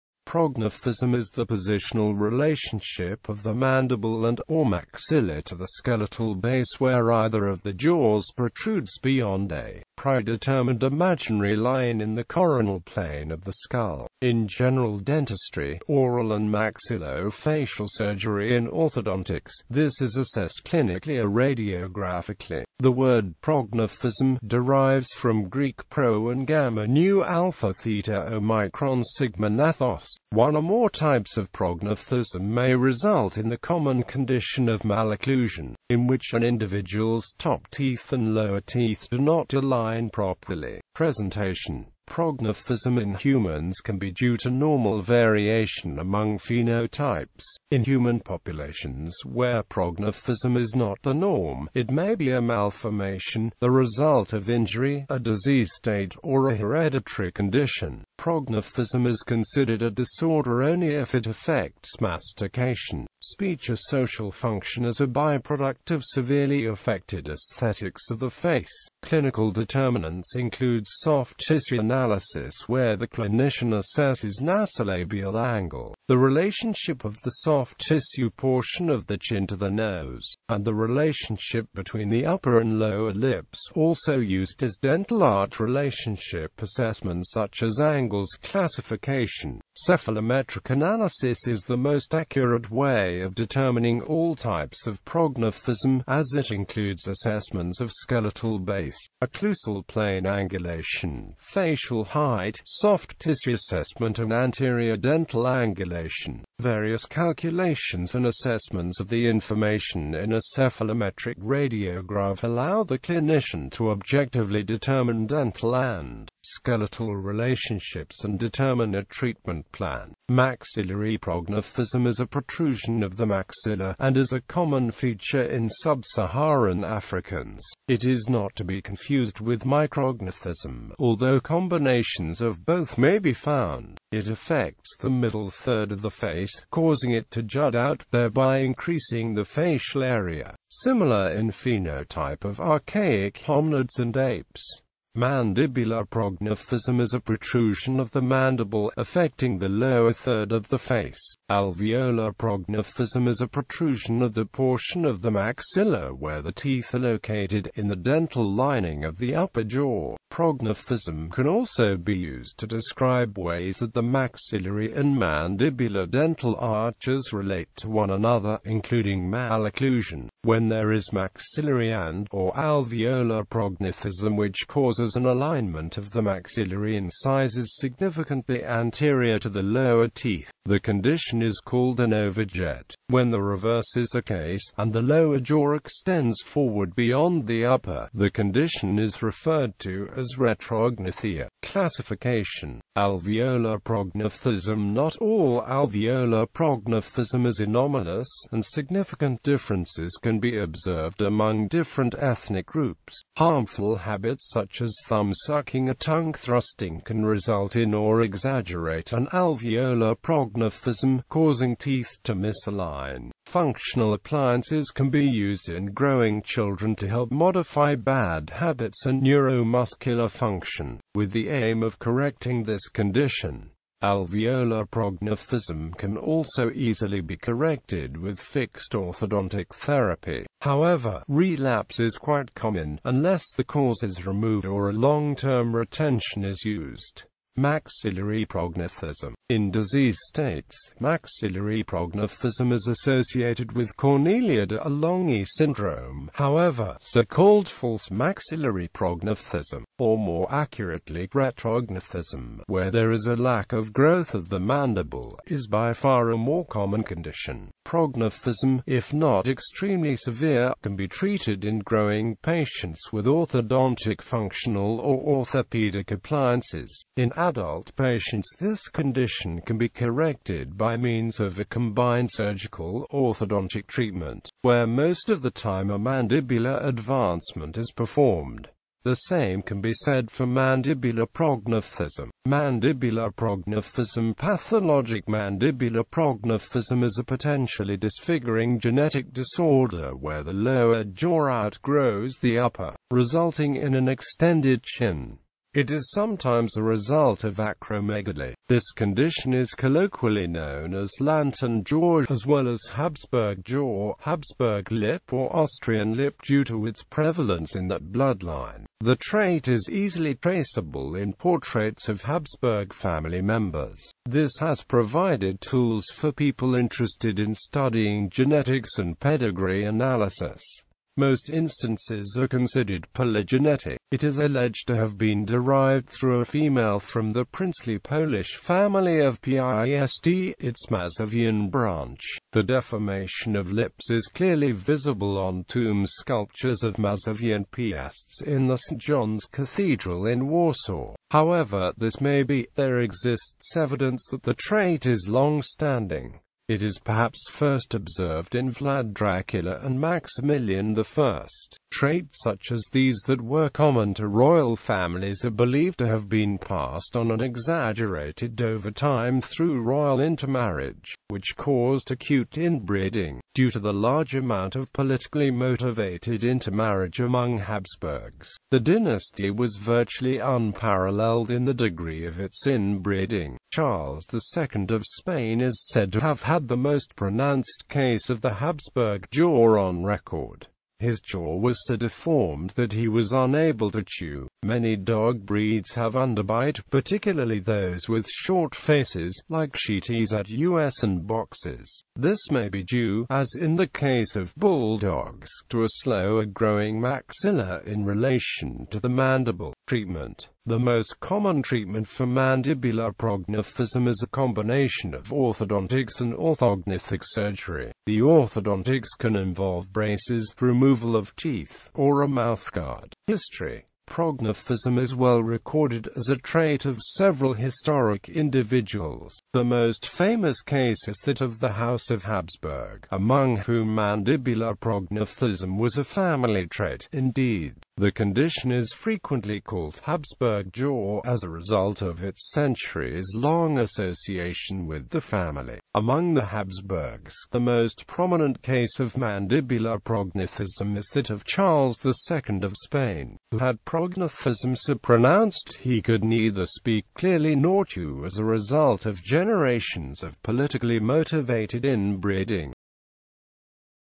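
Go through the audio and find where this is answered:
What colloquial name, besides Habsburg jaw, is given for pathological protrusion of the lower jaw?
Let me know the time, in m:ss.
5:01.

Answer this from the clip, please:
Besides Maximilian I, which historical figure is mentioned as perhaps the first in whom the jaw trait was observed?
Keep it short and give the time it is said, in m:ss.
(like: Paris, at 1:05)
Vlad Dracula, at 5:48.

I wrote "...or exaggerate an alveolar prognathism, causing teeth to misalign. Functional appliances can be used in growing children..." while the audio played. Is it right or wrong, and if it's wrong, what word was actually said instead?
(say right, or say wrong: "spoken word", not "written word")
right.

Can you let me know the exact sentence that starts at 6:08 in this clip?
The dynasty was virtually unparalleled in the degree of its inbreeding.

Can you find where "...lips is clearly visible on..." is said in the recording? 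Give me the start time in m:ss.
5:33.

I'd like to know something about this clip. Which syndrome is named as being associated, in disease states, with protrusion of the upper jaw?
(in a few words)
Cornelia de Lange syndrome.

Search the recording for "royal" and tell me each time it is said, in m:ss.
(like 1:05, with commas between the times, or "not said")
5:54, 5:59.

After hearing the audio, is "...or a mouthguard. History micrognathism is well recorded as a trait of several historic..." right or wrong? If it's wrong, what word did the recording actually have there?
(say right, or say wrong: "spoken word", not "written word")
wrong: "prognathism", not "micrognathism".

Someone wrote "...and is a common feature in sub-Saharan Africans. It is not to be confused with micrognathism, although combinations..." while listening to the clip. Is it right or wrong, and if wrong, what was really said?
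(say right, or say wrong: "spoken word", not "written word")
right.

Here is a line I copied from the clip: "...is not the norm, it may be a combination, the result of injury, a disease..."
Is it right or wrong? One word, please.
wrong.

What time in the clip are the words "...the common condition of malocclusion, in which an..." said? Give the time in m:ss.
0:33.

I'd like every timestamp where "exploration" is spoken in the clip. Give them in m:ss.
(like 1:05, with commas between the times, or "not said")
not said.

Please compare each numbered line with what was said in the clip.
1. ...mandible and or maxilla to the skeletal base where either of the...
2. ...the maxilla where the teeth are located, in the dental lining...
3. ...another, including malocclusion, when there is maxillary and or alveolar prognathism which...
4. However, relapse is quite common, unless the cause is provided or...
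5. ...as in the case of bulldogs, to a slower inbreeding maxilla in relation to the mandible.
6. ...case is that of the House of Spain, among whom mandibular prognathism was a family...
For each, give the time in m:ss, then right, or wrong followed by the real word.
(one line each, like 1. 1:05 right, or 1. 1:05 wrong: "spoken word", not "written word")
1. 0:03 right
2. 2:35 right
3. 2:48 right
4. 3:50 wrong: "removed", not "provided"
5. 6:33 wrong: "growing", not "inbreeding"
6. 7:00 wrong: "Habsburg", not "Spain".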